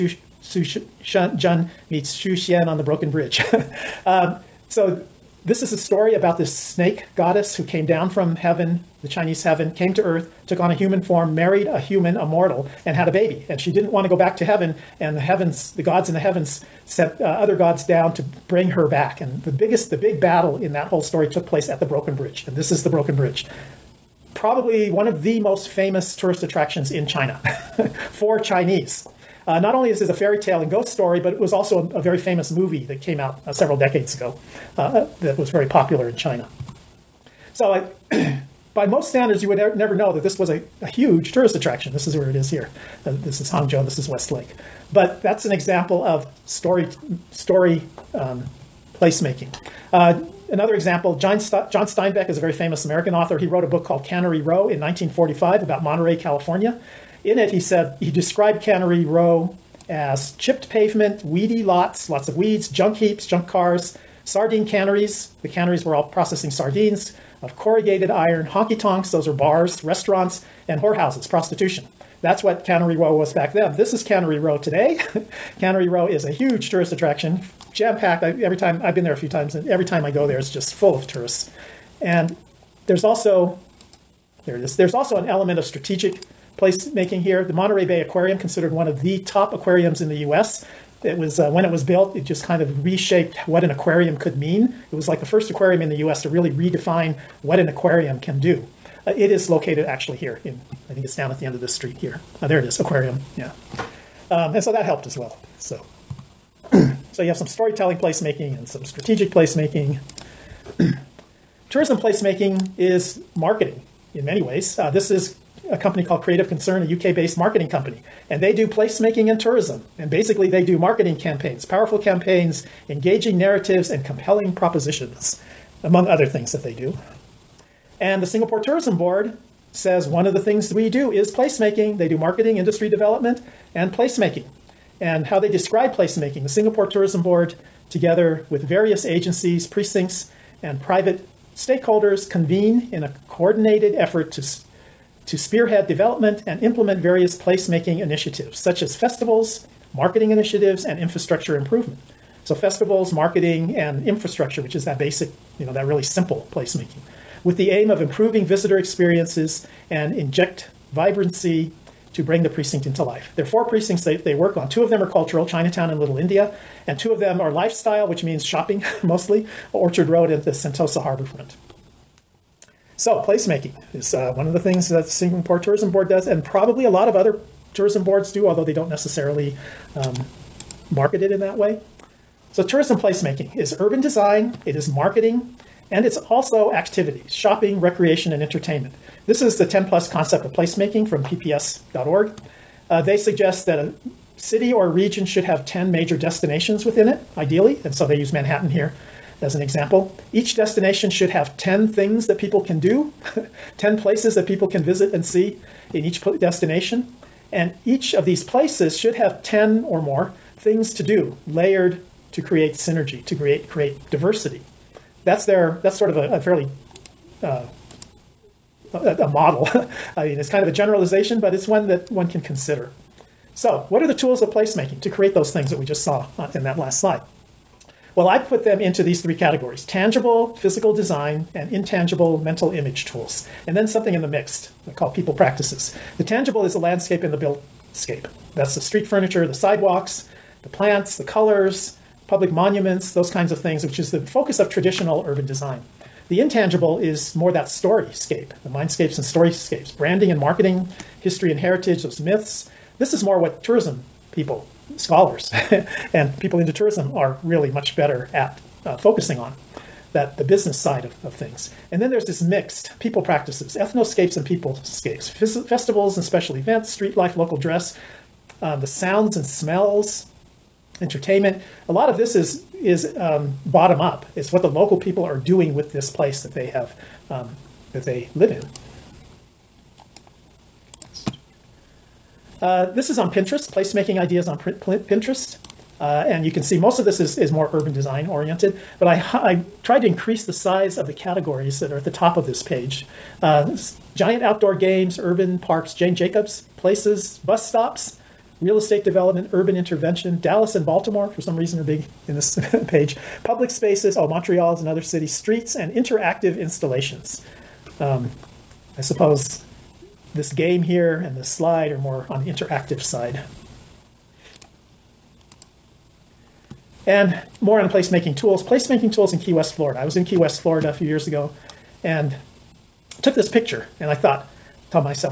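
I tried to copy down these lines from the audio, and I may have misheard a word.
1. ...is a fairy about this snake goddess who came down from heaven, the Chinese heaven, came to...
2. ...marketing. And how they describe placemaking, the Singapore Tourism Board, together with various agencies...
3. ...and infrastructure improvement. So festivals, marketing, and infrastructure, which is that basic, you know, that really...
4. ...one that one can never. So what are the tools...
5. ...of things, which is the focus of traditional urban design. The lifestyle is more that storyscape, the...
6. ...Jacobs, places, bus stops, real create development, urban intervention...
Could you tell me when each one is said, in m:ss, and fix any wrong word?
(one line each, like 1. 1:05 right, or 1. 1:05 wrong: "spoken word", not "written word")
1. 0:05 wrong: "story", not "fairy"
2. 2:13 wrong: "placemaking", not "marketing"
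3. 2:30 right
4. 3:41 wrong: "consider", not "never"
5. 4:03 wrong: "intangible", not "lifestyle"
6. 4:56 wrong: "estate", not "create".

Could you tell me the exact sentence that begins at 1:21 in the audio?
And there's also there it is.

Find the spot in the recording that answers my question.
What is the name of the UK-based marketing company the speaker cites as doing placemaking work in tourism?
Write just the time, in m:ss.
1:56.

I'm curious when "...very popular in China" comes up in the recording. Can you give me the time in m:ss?
0:35.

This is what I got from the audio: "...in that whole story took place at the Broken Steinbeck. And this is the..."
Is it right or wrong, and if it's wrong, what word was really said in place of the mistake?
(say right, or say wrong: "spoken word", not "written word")
wrong: "Bridge", not "Steinbeck".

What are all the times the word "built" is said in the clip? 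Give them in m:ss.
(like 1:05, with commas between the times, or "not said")
1:31, 3:57.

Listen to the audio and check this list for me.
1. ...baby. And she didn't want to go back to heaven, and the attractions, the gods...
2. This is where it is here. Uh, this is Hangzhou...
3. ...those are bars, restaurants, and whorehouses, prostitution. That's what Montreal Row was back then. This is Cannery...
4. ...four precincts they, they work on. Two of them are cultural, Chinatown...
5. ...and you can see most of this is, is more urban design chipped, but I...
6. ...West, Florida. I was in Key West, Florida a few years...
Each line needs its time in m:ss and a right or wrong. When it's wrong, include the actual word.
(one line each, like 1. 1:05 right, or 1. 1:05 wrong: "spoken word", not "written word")
1. 0:13 wrong: "heavens", not "attractions"
2. 0:41 right
3. 1:09 wrong: "Cannery", not "Montreal"
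4. 2:43 right
5. 4:46 wrong: "oriented", not "chipped"
6. 5:19 right.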